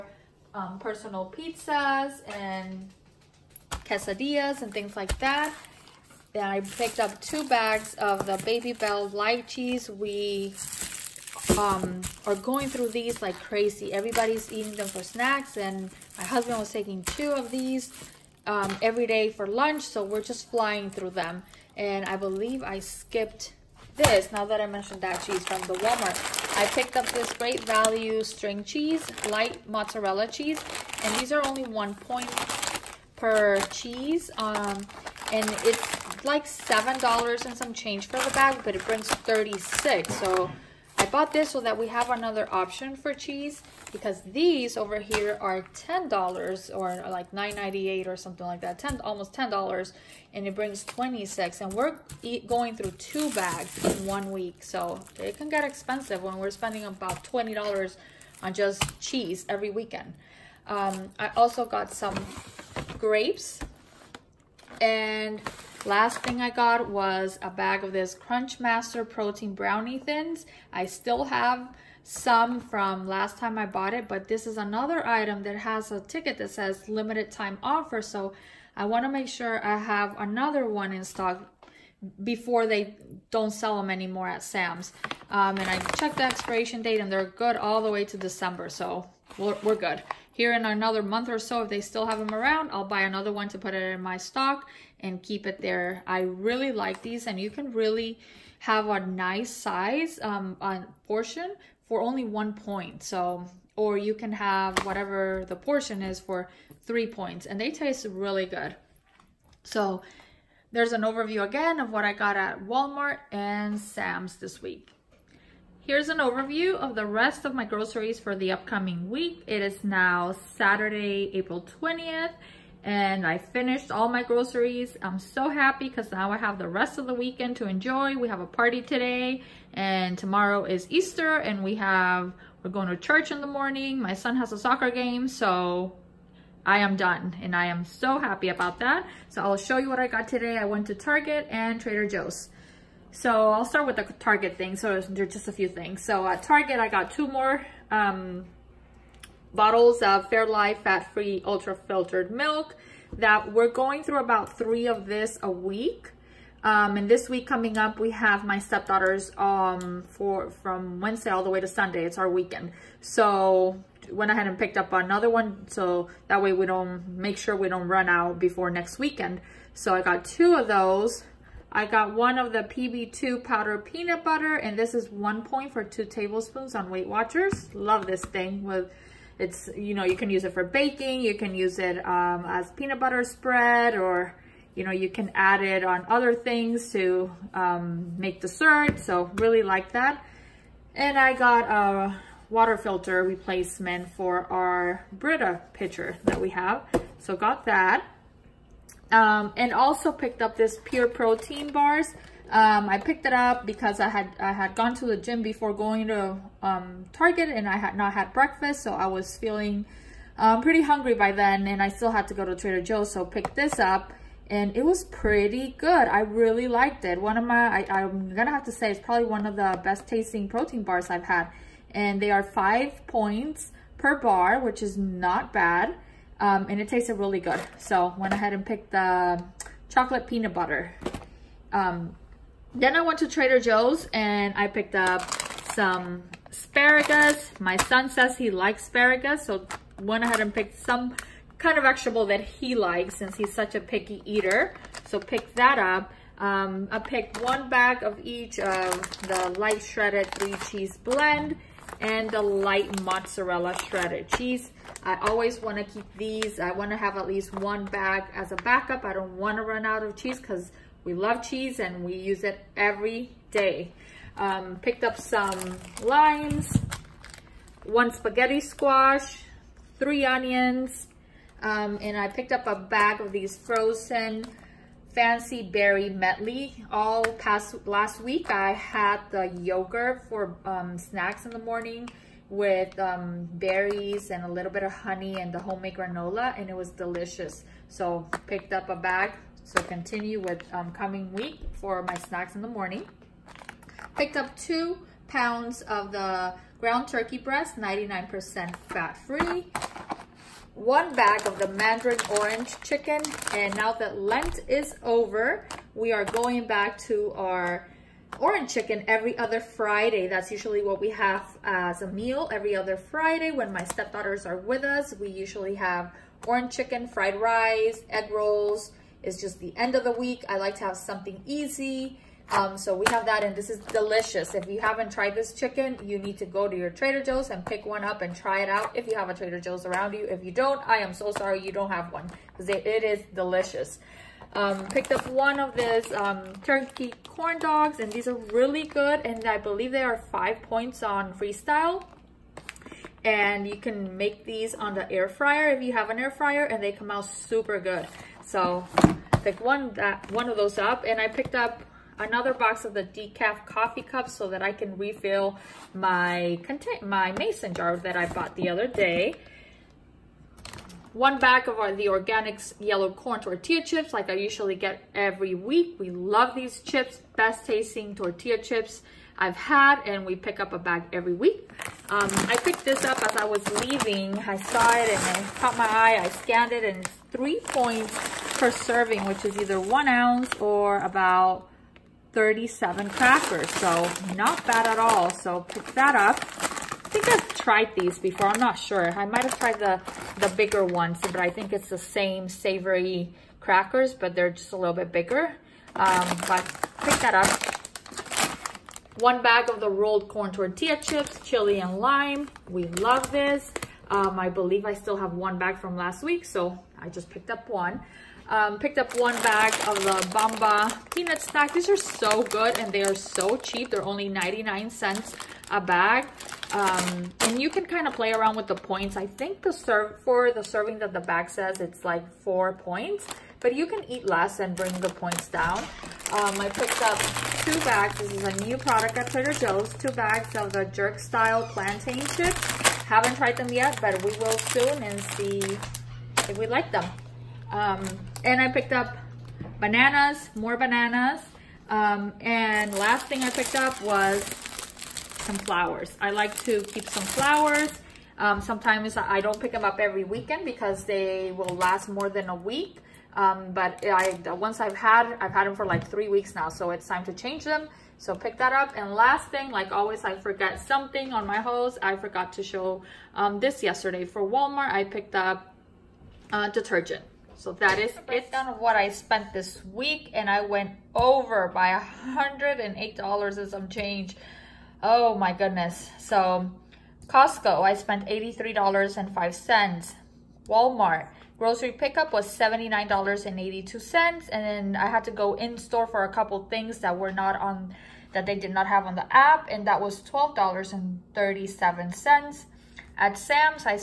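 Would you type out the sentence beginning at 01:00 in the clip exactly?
Um, I also got some grapes and Last thing I got was a bag of this Crunchmaster Protein Brownie Thins.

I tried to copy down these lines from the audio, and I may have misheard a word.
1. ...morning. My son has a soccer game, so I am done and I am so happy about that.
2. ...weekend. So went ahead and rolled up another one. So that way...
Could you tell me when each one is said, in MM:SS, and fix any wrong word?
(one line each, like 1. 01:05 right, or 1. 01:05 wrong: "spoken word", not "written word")
1. 02:13 right
2. 02:42 wrong: "picked", not "rolled".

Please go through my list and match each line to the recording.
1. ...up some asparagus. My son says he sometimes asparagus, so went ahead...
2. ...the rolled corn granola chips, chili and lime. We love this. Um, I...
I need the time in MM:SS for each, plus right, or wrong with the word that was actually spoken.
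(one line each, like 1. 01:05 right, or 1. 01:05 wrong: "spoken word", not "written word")
1. 03:54 wrong: "likes", not "sometimes"
2. 06:39 wrong: "tortilla", not "granola".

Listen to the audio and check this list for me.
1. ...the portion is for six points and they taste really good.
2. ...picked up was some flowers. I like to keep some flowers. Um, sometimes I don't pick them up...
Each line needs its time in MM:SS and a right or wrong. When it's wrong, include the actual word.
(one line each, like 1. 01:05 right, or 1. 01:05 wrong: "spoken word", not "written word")
1. 01:45 wrong: "three", not "six"
2. 07:23 right.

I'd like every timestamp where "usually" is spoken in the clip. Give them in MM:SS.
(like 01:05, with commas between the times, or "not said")
05:10, 05:15, 06:04.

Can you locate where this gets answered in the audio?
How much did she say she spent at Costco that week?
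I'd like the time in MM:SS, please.
07:58.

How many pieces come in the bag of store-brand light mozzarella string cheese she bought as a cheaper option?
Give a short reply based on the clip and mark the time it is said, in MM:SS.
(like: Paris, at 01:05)
36, at 00:38.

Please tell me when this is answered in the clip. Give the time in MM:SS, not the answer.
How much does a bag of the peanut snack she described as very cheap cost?
06:54.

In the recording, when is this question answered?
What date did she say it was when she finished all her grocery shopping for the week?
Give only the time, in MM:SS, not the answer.
02:01.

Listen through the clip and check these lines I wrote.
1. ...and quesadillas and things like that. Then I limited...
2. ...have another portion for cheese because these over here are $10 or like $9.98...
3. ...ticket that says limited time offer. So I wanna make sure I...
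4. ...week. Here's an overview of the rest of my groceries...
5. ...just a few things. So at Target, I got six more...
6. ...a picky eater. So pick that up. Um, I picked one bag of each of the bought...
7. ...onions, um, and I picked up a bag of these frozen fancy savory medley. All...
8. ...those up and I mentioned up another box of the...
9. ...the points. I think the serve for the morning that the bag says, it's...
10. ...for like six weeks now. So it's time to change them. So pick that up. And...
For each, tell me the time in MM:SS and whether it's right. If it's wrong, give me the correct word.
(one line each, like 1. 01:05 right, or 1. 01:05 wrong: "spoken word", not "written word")
1. 00:02 wrong: "picked", not "limited"
2. 00:41 wrong: "option", not "portion"
3. 01:15 right
4. 01:54 right
5. 02:25 wrong: "two", not "six"
6. 04:03 wrong: "light", not "bought"
7. 04:30 wrong: "berry", not "savory"
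8. 05:50 wrong: "picked", not "mentioned"
9. 06:58 wrong: "serving", not "morning"
10. 07:35 wrong: "three", not "six".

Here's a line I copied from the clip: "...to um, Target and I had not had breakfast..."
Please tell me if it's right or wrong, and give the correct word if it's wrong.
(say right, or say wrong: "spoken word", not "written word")
right.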